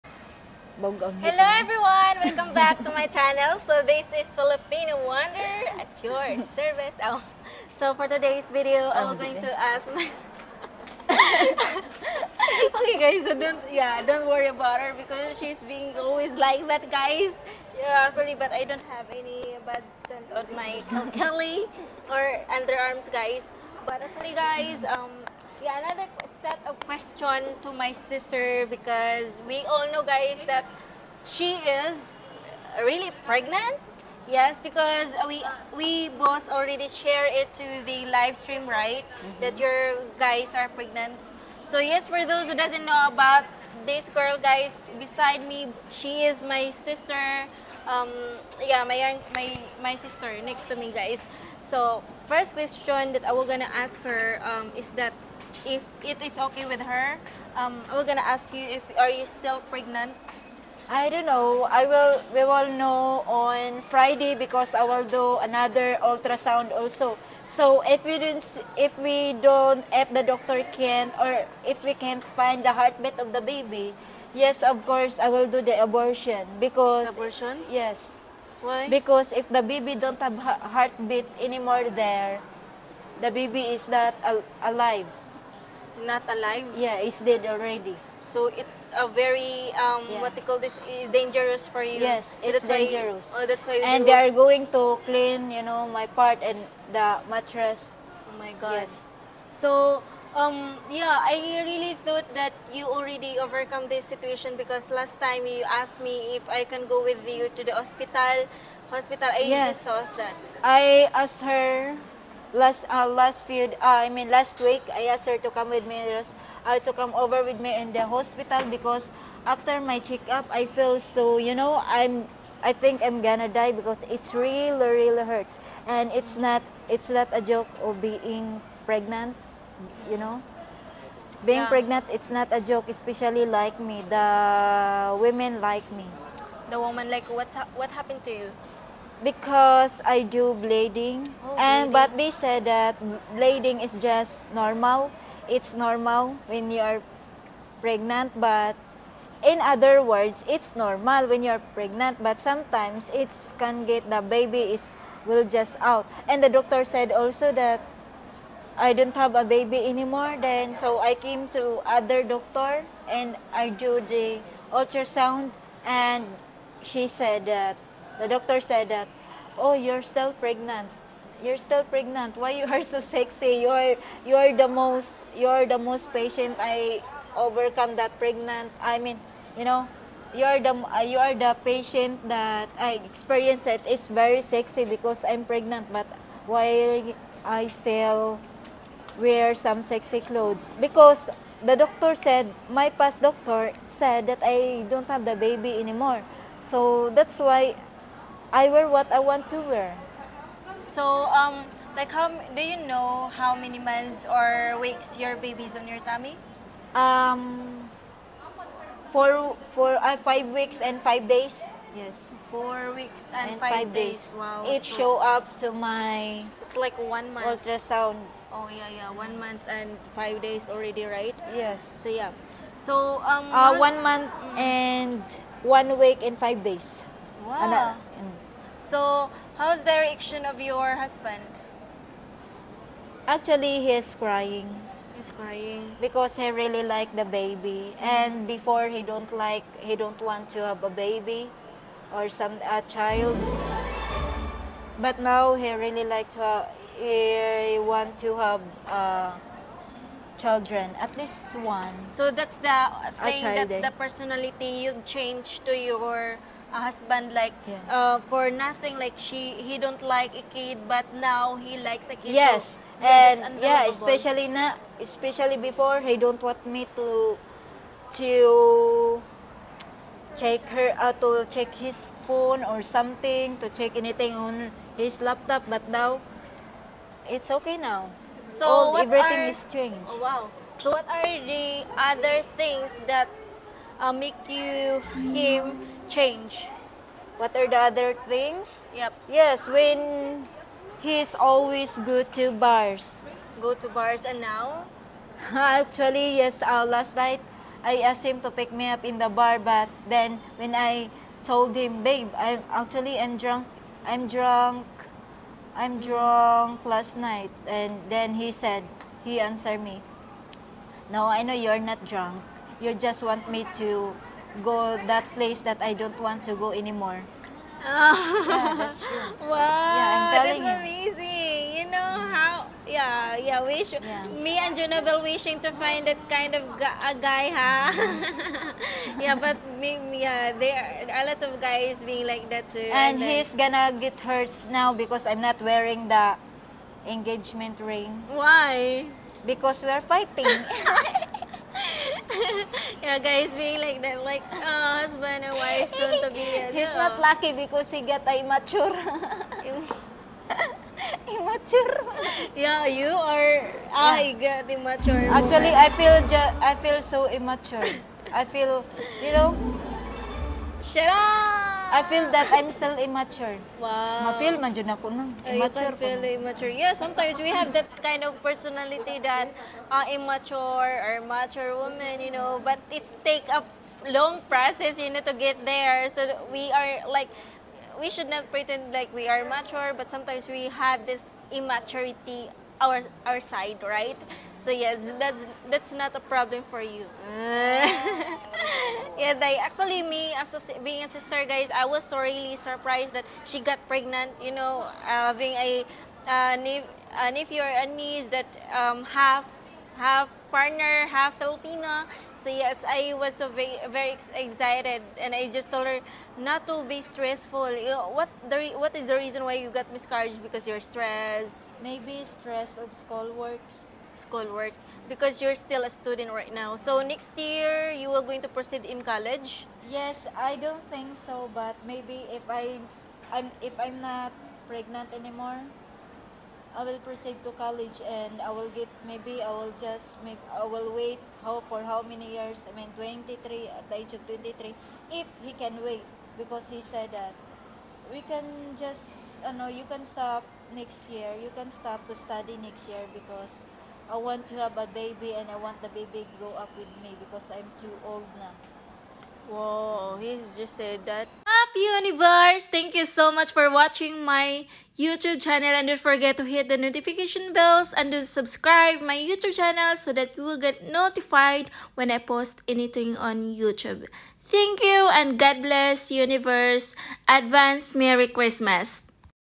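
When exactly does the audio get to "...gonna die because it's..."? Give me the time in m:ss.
2:03.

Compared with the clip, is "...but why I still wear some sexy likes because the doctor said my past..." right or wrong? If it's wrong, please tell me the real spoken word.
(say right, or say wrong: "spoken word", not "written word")
wrong: "clothes", not "likes".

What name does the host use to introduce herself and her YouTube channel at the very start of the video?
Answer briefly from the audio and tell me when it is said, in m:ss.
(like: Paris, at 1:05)
Filipina Wanderer, at 0:04.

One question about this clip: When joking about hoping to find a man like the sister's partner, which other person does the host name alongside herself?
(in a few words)
Junabel.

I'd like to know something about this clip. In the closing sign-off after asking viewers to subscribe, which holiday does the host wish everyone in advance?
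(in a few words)
Christmas.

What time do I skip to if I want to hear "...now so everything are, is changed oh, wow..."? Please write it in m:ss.
4:37.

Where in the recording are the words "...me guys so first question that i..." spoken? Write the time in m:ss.
0:50.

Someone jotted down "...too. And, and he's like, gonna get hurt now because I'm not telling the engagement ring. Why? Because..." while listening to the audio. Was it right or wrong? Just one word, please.
wrong.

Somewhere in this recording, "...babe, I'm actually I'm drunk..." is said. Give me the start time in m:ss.
5:02.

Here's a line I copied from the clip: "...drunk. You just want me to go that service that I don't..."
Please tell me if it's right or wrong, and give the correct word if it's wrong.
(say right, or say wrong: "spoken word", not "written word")
wrong: "place", not "service".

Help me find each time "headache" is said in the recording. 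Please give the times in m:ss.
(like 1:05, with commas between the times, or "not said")
not said.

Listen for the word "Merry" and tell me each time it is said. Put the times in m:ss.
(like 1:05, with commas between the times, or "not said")
7:47.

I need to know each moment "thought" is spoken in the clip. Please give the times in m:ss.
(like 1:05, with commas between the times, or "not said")
1:42, 1:49.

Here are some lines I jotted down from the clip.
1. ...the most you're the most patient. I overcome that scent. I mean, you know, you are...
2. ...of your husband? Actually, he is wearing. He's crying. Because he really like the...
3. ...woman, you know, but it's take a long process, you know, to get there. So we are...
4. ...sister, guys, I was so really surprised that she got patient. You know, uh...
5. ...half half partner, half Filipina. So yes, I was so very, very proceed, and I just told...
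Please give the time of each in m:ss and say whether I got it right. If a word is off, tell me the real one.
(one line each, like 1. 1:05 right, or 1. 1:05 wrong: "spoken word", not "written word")
1. 2:54 wrong: "pregnant", not "scent"
2. 3:50 wrong: "crying", not "wearing"
3. 6:11 right
4. 6:31 wrong: "pregnant", not "patient"
5. 6:39 wrong: "excited", not "proceed".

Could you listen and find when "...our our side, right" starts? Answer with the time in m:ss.
6:22.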